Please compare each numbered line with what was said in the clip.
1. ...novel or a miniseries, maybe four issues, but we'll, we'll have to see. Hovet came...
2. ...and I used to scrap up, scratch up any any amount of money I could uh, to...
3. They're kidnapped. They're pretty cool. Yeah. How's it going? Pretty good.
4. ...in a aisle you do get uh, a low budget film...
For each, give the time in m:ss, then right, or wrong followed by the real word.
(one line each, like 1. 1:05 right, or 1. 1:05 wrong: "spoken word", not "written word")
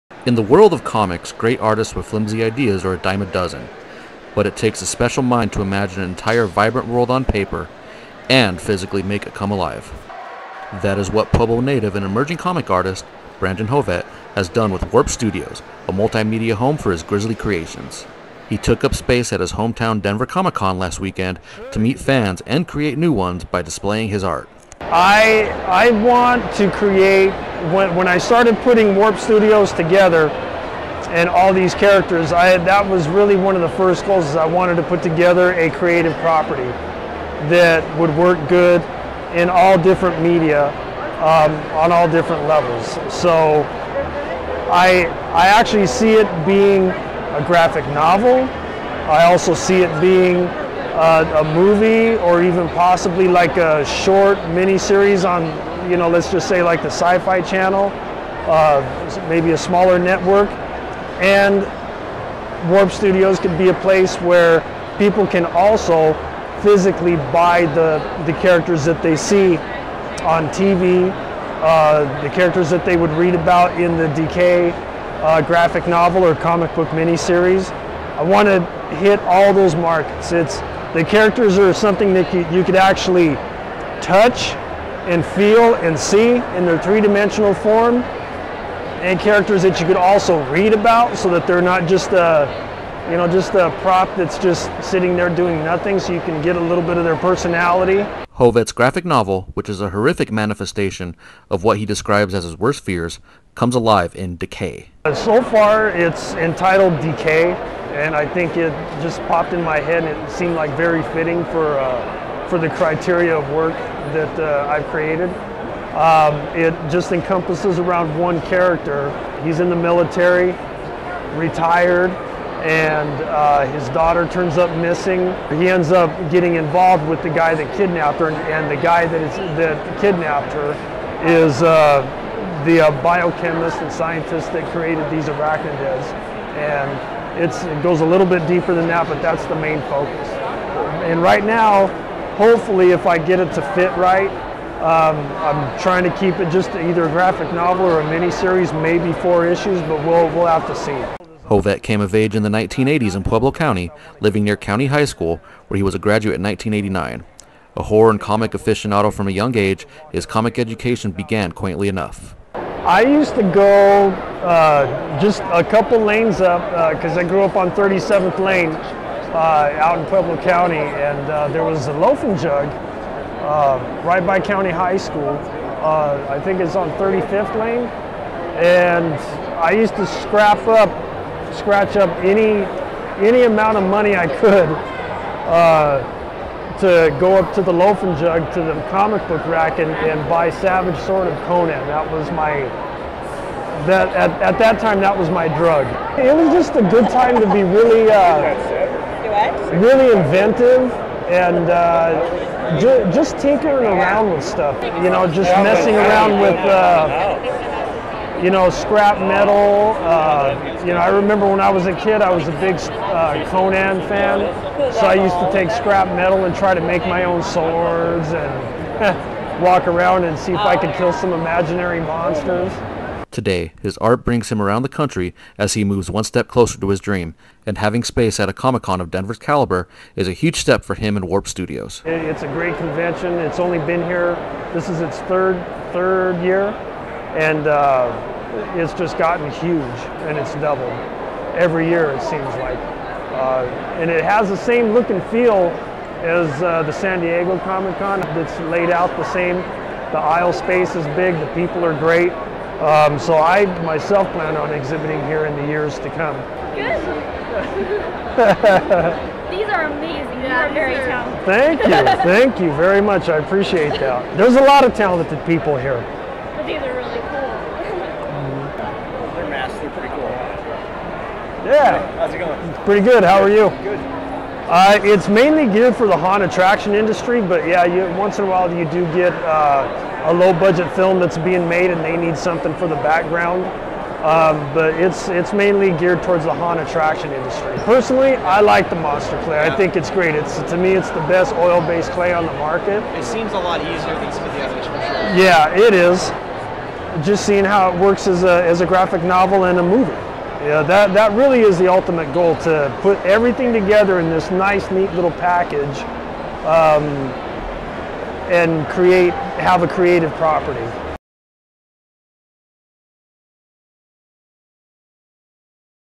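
1. 2:27 right
2. 2:58 right
3. 4:29 wrong: "masked", not "kidnapped"
4. 4:38 wrong: "while", not "aisle".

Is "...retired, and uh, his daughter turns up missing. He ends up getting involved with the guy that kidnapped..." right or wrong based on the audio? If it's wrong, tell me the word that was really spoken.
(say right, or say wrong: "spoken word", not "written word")
right.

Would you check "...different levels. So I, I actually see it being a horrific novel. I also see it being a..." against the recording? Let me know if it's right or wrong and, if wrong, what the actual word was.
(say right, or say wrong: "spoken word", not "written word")
wrong: "graphic", not "horrific".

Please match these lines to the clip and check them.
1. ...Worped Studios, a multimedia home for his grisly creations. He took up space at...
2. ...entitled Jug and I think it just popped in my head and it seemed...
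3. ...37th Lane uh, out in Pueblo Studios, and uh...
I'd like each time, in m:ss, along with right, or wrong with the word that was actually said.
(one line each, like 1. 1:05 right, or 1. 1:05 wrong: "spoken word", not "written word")
1. 0:14 right
2. 1:46 wrong: "Decay", not "Jug"
3. 2:47 wrong: "County", not "Studios".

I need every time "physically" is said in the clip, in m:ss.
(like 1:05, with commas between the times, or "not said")
0:08, 1:06.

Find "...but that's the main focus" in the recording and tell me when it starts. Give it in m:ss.
2:19.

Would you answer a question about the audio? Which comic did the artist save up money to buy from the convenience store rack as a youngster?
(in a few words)
Savage Sword of Conan.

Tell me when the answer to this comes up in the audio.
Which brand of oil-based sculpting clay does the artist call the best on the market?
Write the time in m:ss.
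4:48.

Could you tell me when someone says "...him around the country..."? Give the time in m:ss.
3:44.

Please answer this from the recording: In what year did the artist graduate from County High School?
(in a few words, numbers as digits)
1989.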